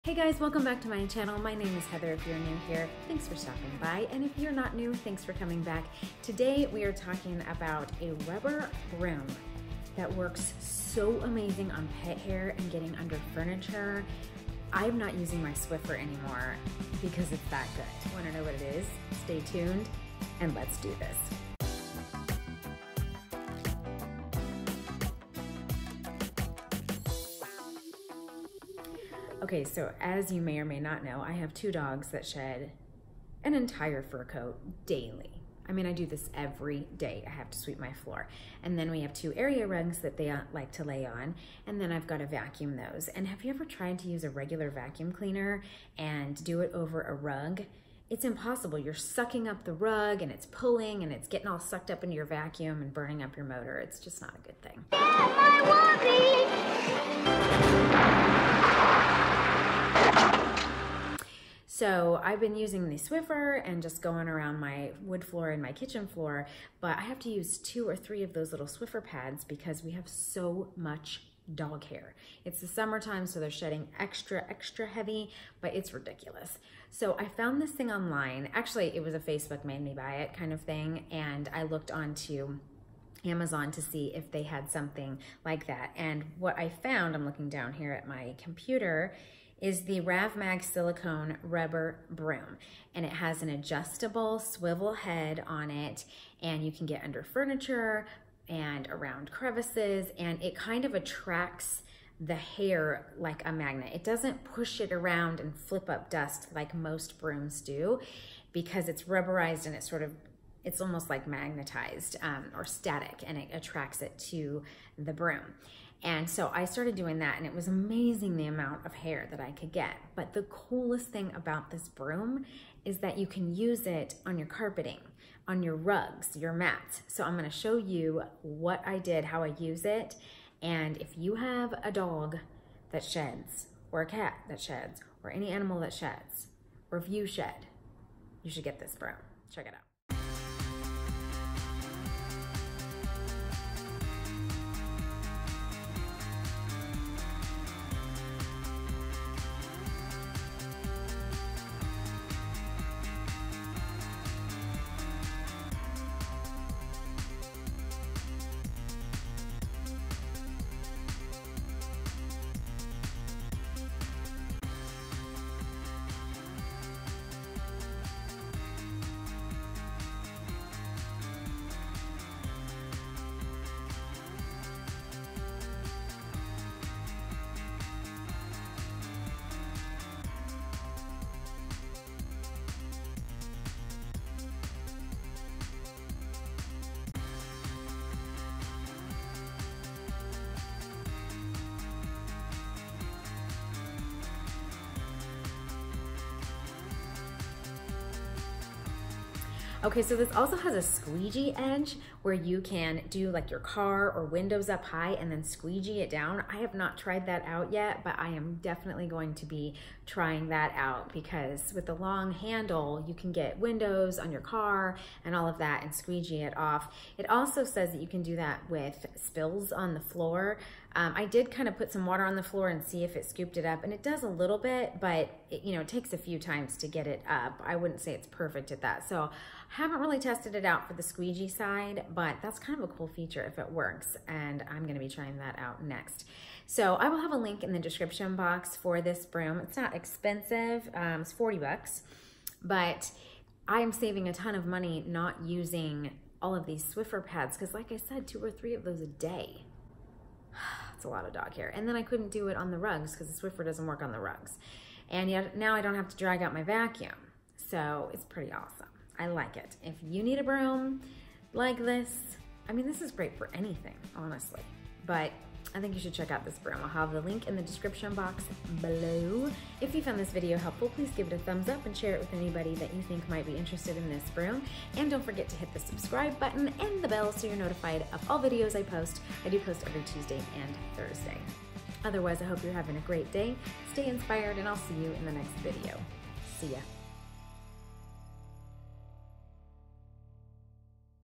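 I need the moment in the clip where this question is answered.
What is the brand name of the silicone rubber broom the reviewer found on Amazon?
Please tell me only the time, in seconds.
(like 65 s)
90 s.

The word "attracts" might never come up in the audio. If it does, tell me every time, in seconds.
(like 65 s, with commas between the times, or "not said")
100 s, 113 s.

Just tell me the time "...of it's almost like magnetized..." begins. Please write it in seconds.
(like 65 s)
110 s.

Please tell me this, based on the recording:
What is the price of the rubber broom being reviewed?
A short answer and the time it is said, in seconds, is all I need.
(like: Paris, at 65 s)
$40, at 241 s.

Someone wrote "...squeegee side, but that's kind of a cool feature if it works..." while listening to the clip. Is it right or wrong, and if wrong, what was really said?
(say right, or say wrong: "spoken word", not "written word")
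right.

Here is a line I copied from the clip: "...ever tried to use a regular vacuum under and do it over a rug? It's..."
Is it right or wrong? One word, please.
wrong.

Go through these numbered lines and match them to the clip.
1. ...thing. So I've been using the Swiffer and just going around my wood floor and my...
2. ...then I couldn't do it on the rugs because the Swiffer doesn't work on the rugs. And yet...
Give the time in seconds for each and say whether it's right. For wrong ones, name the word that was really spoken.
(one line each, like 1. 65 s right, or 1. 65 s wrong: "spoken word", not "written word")
1. 54 s right
2. 251 s right.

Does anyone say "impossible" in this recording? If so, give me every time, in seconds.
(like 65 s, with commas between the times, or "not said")
48 s.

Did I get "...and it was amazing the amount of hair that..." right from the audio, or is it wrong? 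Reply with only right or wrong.
right.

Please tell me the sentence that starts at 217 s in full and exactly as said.
It also says that you can do that with spills on the floor.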